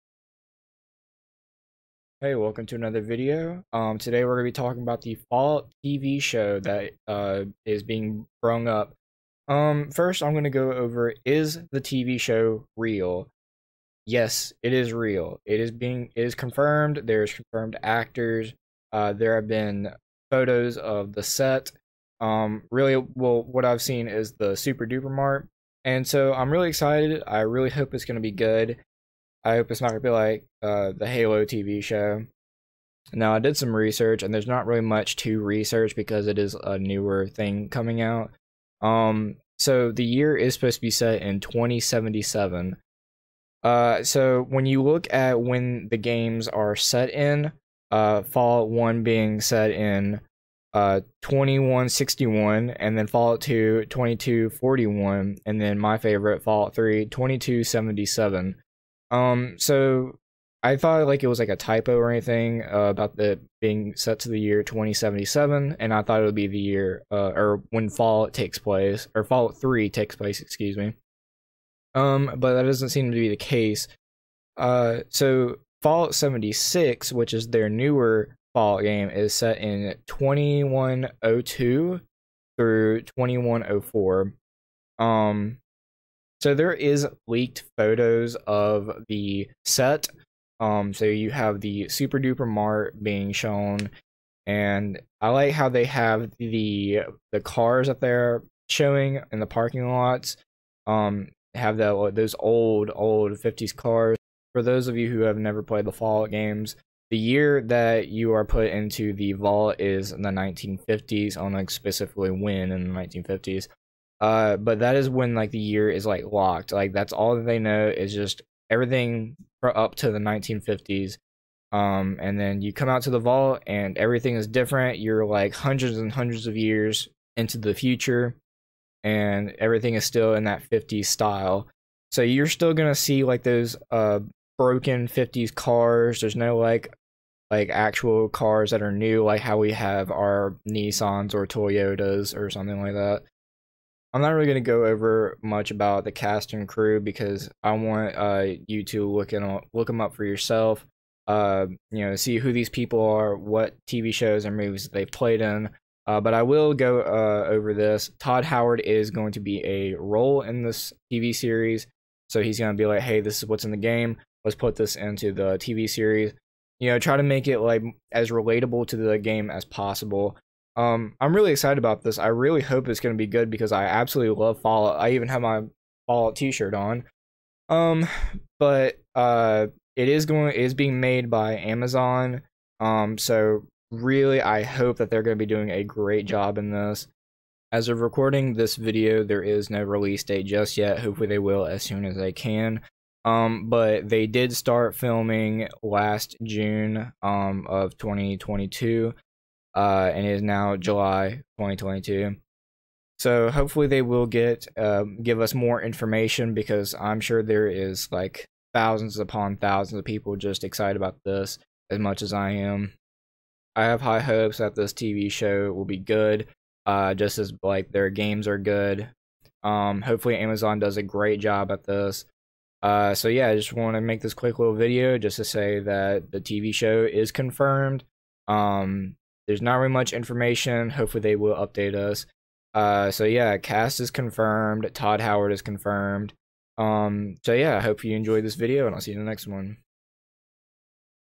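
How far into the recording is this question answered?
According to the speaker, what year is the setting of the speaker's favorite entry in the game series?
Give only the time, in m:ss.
0:57.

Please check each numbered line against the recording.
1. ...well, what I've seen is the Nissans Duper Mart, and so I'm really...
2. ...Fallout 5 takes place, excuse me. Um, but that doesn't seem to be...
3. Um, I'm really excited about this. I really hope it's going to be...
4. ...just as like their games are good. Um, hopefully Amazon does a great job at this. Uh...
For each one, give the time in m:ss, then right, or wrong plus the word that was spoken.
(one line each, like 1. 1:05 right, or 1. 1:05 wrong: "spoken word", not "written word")
1. 0:22 wrong: "Super", not "Nissans"
2. 1:09 wrong: "3", not "5"
3. 2:50 right
4. 3:37 right.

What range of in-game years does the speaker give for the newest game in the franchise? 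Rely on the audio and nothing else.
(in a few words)
2102 through 2104.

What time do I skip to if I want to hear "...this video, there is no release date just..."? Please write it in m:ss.
3:08.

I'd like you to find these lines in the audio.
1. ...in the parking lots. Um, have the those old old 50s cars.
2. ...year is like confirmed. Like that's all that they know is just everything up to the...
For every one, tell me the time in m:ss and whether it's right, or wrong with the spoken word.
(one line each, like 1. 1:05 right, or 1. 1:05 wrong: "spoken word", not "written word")
1. 1:39 right
2. 1:55 wrong: "locked", not "confirmed".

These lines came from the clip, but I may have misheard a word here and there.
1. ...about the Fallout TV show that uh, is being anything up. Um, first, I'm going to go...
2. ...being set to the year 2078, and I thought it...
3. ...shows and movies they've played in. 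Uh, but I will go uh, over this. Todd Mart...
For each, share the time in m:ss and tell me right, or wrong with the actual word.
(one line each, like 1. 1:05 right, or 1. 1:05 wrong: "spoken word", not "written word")
1. 0:04 wrong: "brung", not "anything"
2. 1:03 wrong: "2077", not "2078"
3. 2:34 wrong: "Howard", not "Mart".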